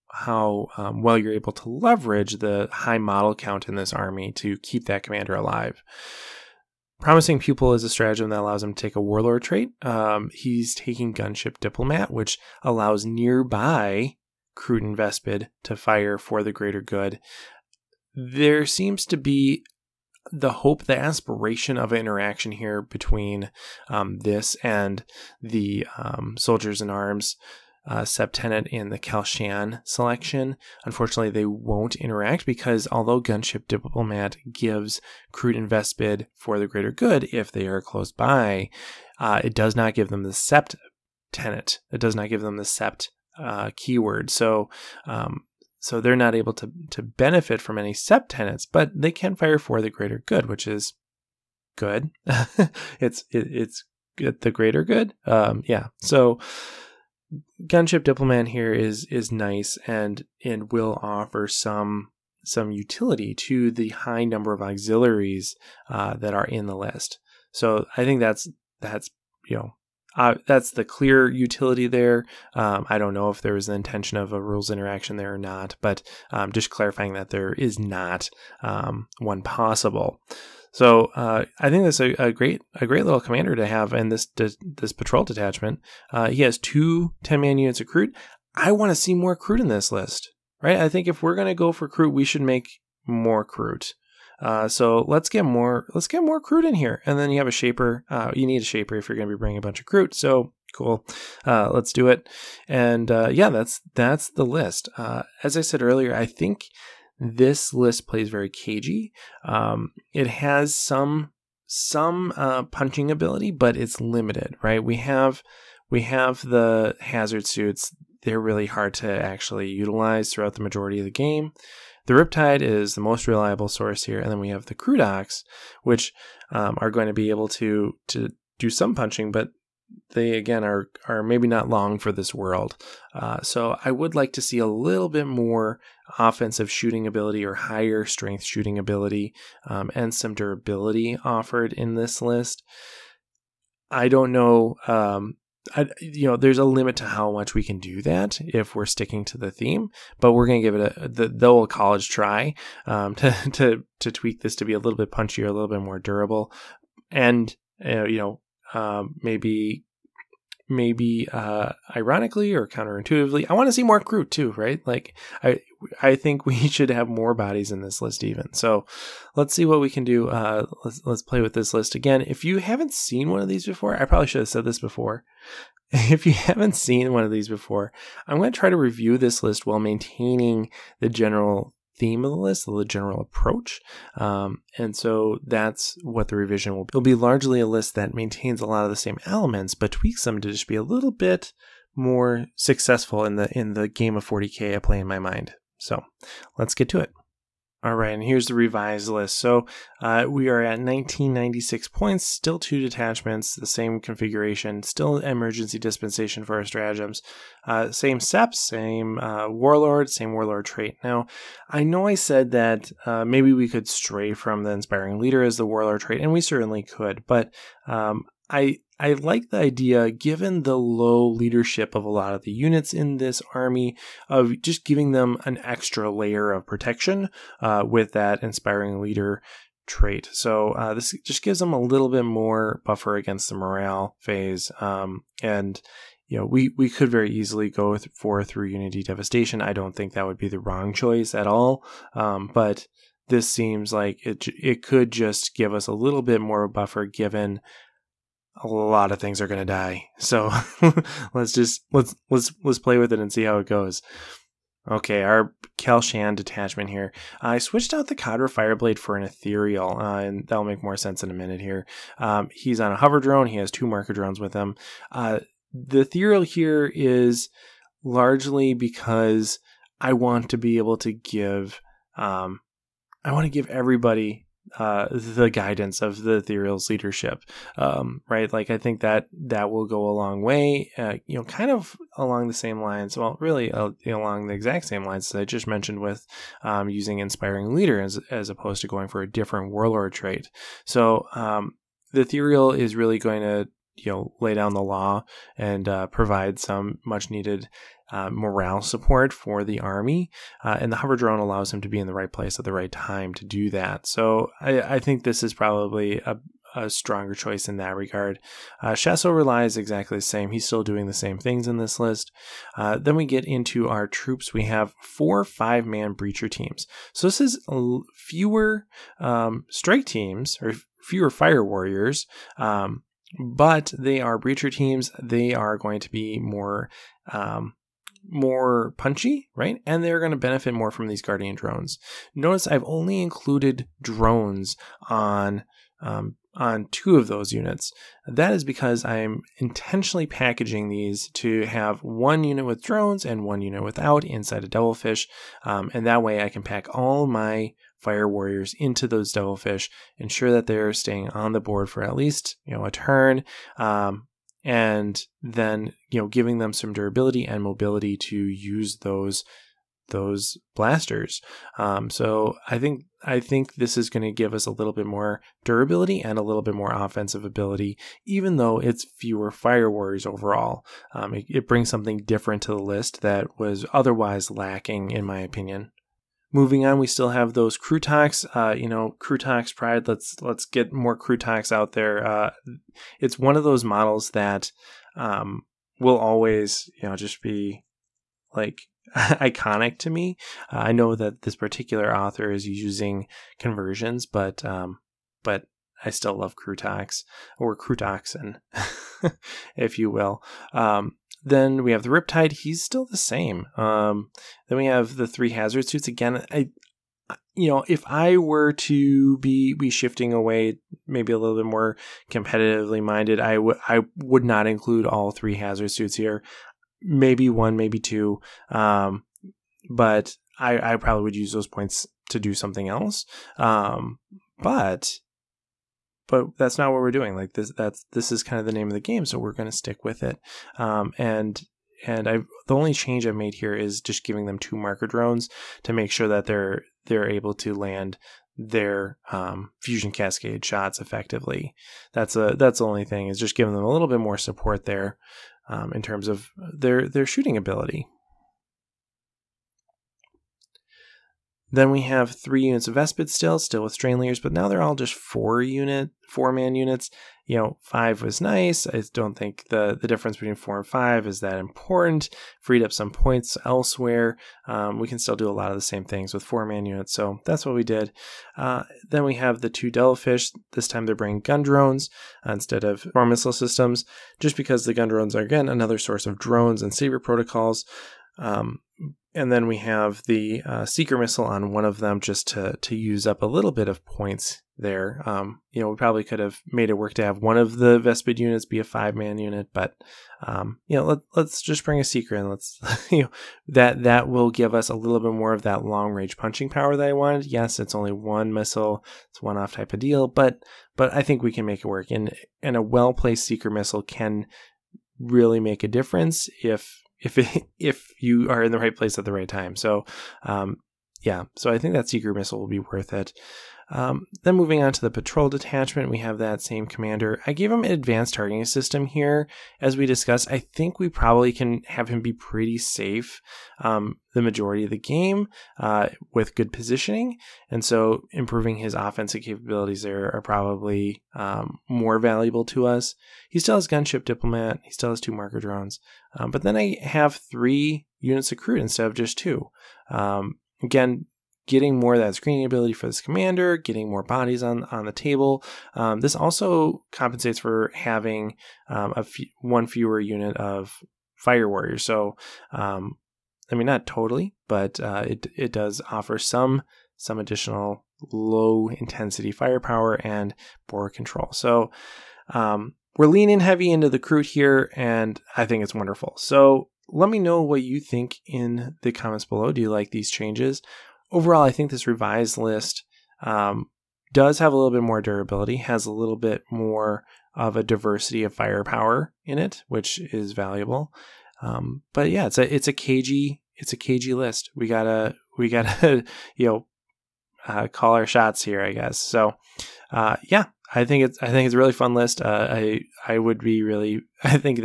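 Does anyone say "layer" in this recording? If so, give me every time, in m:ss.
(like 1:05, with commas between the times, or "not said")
3:46, 7:34.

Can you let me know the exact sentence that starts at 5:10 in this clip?
He's still doing the same things in this list.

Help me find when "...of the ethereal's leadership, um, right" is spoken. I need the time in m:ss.
4:36.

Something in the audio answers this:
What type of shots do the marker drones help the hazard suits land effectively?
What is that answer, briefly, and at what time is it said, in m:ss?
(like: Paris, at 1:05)
Fusion cascade, at 7:19.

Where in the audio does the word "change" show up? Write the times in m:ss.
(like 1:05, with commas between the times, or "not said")
7:12, 9:30.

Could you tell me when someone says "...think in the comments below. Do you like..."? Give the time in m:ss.
9:27.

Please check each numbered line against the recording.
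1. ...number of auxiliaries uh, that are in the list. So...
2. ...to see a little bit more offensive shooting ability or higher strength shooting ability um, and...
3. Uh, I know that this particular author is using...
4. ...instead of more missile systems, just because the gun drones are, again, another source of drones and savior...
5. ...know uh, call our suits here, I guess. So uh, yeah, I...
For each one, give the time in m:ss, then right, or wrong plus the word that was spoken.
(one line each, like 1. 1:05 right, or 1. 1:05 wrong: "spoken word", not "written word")
1. 1:04 right
2. 2:14 right
3. 6:30 right
4. 7:52 right
5. 9:46 wrong: "shots", not "suits".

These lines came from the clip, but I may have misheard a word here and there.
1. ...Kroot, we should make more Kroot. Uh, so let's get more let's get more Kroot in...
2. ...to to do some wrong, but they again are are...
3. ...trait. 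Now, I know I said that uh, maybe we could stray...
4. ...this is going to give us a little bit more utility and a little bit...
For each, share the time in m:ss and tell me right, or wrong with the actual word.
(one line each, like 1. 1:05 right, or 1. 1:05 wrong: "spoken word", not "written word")
1. 1:31 right
2. 2:07 wrong: "punching", not "wrong"
3. 3:30 right
4. 6:03 wrong: "durability", not "utility".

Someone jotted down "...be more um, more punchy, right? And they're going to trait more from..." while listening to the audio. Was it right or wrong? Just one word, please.
wrong.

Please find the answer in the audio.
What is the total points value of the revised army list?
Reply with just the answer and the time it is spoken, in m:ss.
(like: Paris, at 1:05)
1996, at 3:20.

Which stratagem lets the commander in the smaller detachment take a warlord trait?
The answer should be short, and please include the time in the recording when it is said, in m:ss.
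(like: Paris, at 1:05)
Promising Pupil, at 0:06.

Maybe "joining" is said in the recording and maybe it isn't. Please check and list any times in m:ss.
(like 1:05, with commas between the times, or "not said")
not said.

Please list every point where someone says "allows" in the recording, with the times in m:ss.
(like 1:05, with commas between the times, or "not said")
0:08, 0:12, 5:01.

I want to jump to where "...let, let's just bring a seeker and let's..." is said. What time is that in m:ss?
8:11.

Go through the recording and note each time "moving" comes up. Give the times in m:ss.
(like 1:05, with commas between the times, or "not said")
6:16, 8:34.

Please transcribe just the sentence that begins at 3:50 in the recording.
So uh, this just gives them a little bit more buffer against the morale phase.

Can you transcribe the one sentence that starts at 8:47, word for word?
And so improving his offensive capabilities there are probably um, more valuable to us.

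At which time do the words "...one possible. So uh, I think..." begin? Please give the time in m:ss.
1:19.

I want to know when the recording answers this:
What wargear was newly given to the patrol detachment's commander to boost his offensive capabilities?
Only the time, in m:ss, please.
8:37.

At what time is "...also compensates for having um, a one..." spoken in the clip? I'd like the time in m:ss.
9:06.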